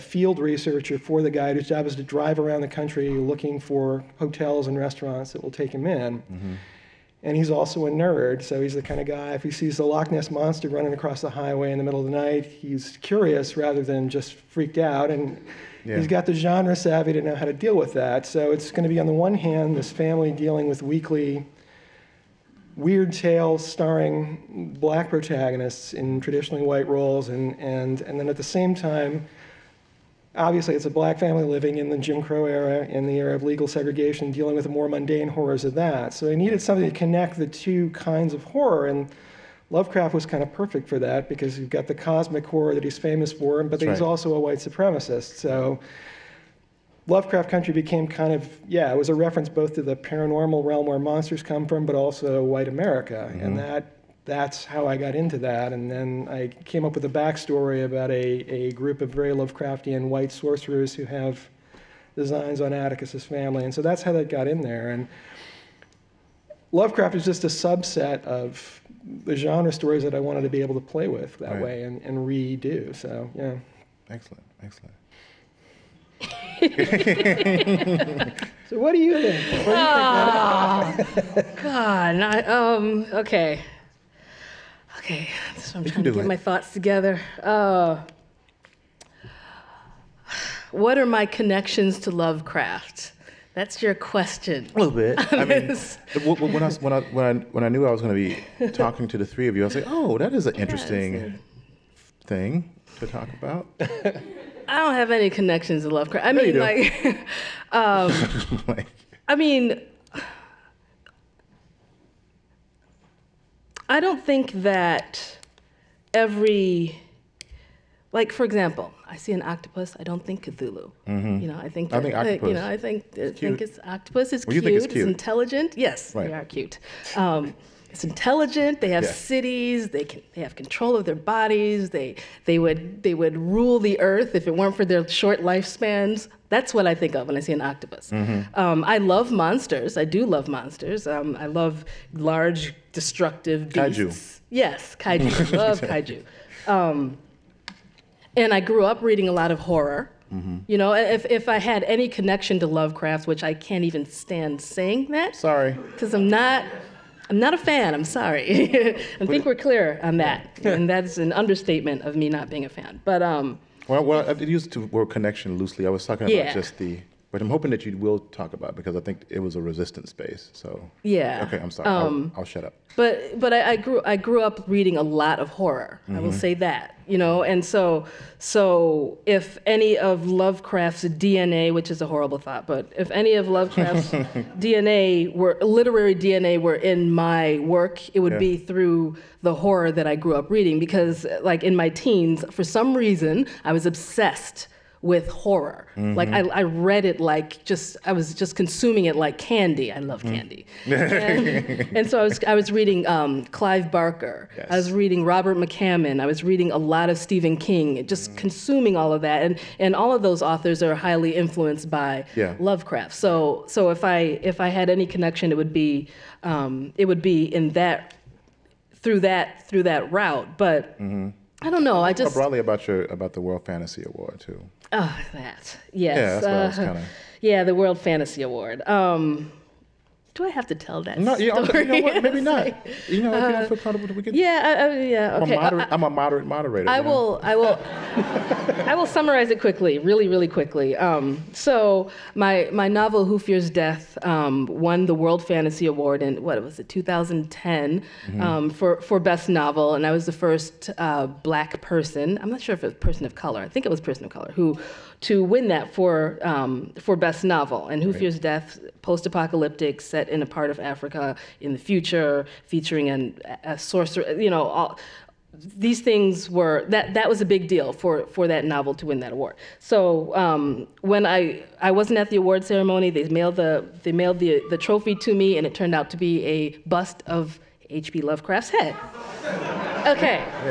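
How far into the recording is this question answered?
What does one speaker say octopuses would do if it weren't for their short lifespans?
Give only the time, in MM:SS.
02:13.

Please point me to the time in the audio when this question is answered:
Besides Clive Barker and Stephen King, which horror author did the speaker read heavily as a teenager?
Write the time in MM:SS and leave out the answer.
03:25.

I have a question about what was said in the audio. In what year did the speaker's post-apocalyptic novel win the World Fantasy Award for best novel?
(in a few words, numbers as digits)
2010.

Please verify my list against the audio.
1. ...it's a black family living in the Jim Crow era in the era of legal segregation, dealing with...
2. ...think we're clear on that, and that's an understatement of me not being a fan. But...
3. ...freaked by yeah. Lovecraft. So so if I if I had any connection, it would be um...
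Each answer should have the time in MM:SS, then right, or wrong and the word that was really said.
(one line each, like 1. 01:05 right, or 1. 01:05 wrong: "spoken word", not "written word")
1. 00:30 right
2. 02:39 right
3. 03:31 wrong: "influenced", not "freaked".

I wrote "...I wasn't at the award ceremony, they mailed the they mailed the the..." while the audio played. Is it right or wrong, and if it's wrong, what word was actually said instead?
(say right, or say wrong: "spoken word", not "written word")
right.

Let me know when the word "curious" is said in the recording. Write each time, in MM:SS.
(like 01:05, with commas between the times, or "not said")
00:13.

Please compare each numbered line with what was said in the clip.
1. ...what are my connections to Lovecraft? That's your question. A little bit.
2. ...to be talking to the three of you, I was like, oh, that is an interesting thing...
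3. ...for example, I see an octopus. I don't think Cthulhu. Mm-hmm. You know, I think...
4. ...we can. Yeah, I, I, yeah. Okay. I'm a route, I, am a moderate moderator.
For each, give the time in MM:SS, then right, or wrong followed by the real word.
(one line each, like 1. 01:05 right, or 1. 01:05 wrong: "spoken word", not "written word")
1. 01:30 right
2. 01:38 right
3. 01:58 right
4. 03:54 wrong: "moderate", not "route".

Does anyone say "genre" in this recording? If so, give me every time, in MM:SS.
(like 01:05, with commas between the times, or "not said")
00:16, 01:09.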